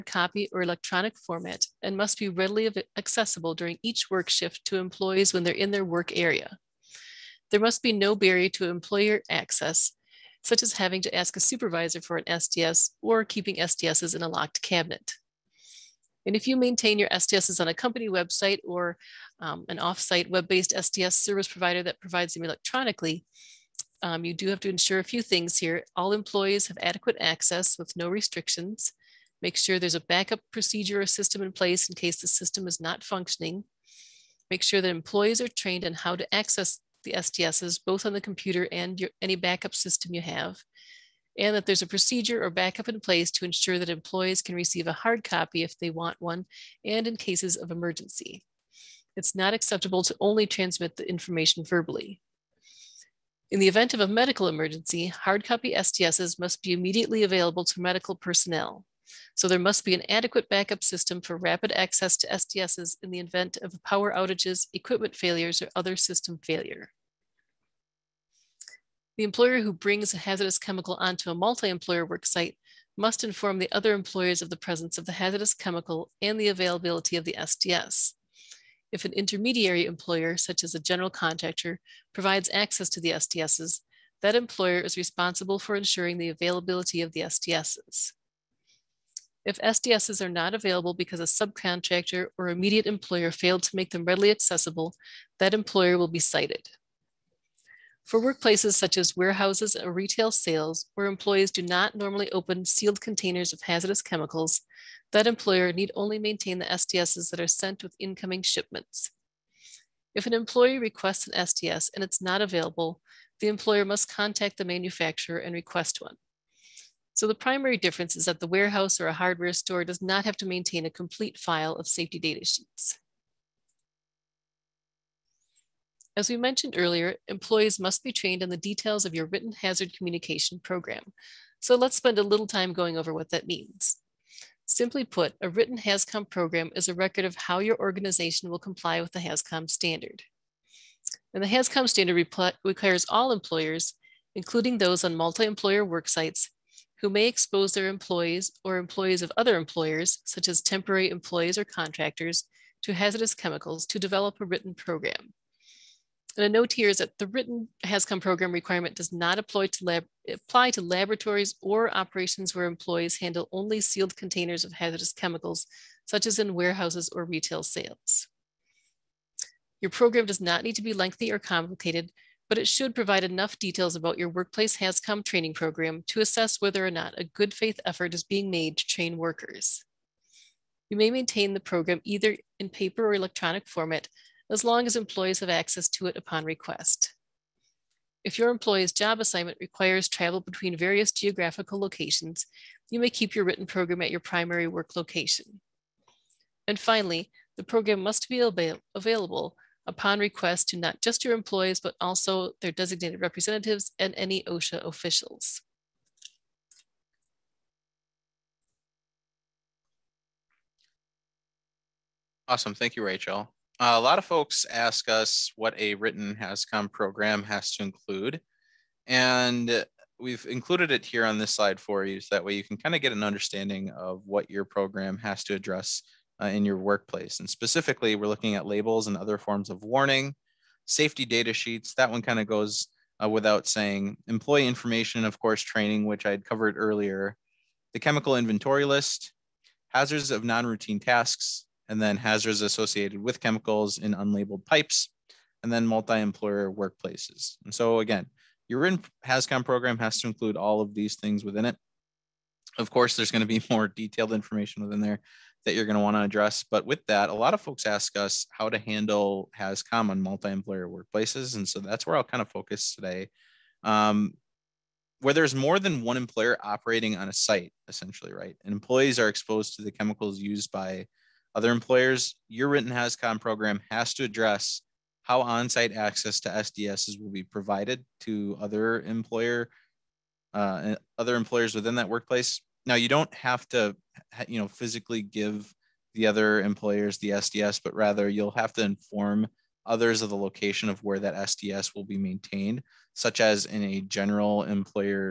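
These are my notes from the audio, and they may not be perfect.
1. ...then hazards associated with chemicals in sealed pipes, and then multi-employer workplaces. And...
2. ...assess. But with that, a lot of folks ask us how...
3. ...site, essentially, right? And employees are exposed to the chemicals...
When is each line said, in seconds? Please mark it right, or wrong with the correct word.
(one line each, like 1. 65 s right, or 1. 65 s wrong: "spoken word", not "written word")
1. 242 s wrong: "unlabeled", not "sealed"
2. 256 s wrong: "address", not "assess"
3. 267 s right.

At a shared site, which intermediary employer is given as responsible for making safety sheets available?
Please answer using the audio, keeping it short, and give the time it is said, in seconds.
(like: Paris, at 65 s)
General contractor, at 80 s.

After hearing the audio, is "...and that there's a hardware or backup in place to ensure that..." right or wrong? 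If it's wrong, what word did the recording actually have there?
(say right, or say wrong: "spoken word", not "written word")
wrong: "procedure", not "hardware".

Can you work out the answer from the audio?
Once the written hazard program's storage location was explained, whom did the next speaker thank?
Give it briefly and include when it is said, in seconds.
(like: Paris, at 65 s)
Rachel, at 213 s.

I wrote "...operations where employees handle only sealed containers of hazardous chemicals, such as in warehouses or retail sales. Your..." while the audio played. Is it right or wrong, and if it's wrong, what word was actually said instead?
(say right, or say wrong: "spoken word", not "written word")
right.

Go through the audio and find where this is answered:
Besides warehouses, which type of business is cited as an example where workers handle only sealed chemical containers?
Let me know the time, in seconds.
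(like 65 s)
119 s.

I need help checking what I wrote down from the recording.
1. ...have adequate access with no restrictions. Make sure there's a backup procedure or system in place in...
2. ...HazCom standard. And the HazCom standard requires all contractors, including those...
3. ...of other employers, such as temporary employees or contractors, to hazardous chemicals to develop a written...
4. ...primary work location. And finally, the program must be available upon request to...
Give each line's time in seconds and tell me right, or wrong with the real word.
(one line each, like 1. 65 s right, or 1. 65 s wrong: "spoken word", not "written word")
1. 26 s right
2. 139 s wrong: "employers", not "contractors"
3. 149 s right
4. 194 s right.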